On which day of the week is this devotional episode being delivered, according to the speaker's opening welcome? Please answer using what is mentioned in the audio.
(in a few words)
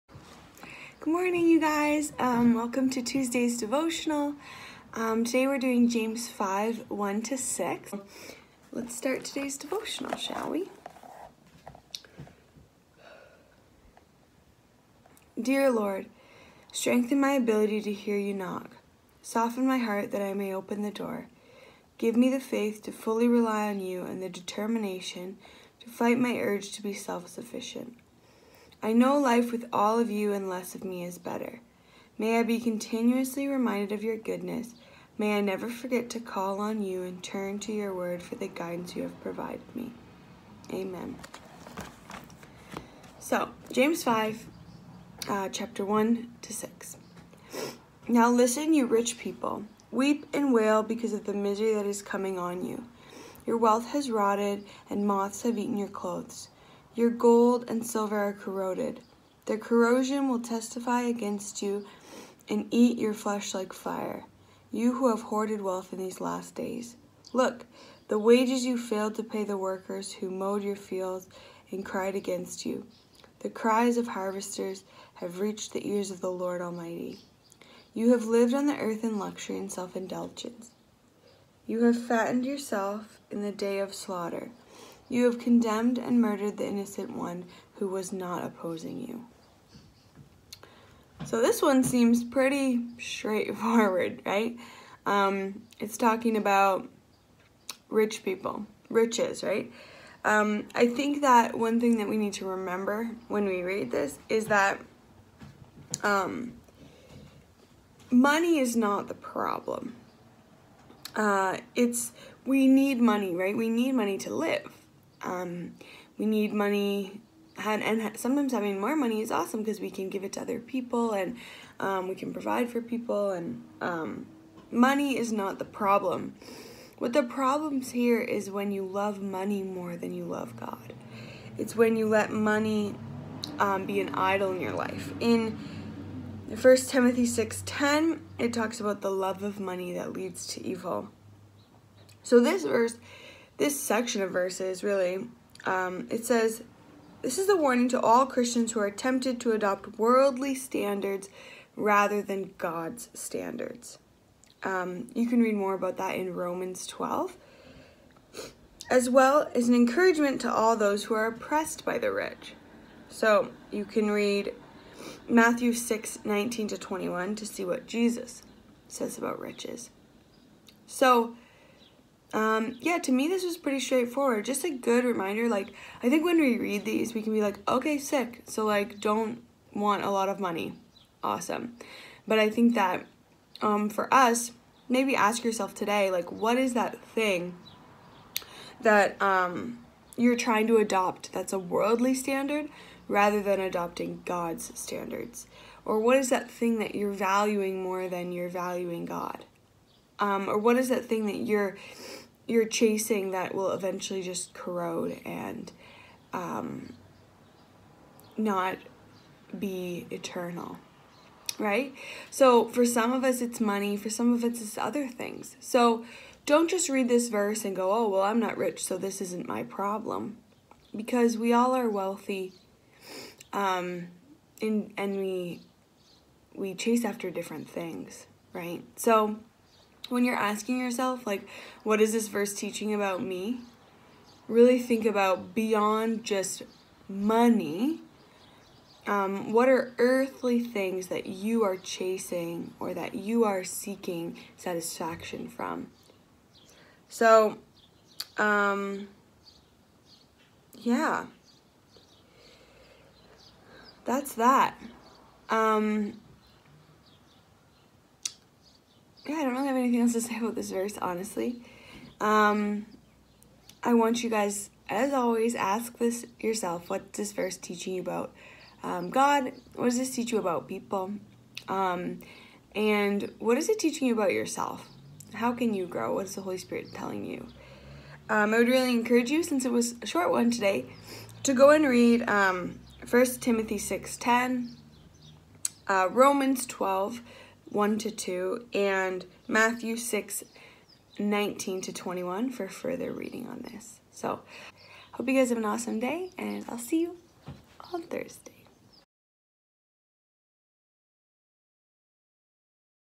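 Tuesday.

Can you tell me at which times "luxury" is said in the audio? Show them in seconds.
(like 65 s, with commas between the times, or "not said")
79 s.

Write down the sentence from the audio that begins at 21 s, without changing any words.
Give me the faith to fully rely on you and the determination to fight my urge to be self sufficient.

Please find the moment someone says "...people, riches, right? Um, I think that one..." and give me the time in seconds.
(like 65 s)
98 s.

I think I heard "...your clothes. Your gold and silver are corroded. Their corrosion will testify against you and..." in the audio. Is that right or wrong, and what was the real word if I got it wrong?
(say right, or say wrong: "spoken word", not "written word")
right.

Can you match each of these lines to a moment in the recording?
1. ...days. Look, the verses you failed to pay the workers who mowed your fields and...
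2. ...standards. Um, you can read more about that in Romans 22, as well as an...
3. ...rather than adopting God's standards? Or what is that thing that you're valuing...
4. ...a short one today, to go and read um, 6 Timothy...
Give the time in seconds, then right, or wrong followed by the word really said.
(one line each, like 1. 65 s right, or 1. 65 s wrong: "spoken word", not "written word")
1. 66 s wrong: "wages", not "verses"
2. 153 s wrong: "12", not "22"
3. 193 s right
4. 280 s wrong: "1", not "6".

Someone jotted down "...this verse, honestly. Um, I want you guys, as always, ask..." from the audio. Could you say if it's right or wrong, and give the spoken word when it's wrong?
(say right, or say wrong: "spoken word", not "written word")
right.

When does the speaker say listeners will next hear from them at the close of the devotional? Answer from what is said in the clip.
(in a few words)
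Thursday.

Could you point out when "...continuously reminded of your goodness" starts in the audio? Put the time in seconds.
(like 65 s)
32 s.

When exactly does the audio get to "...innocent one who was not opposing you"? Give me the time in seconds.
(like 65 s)
86 s.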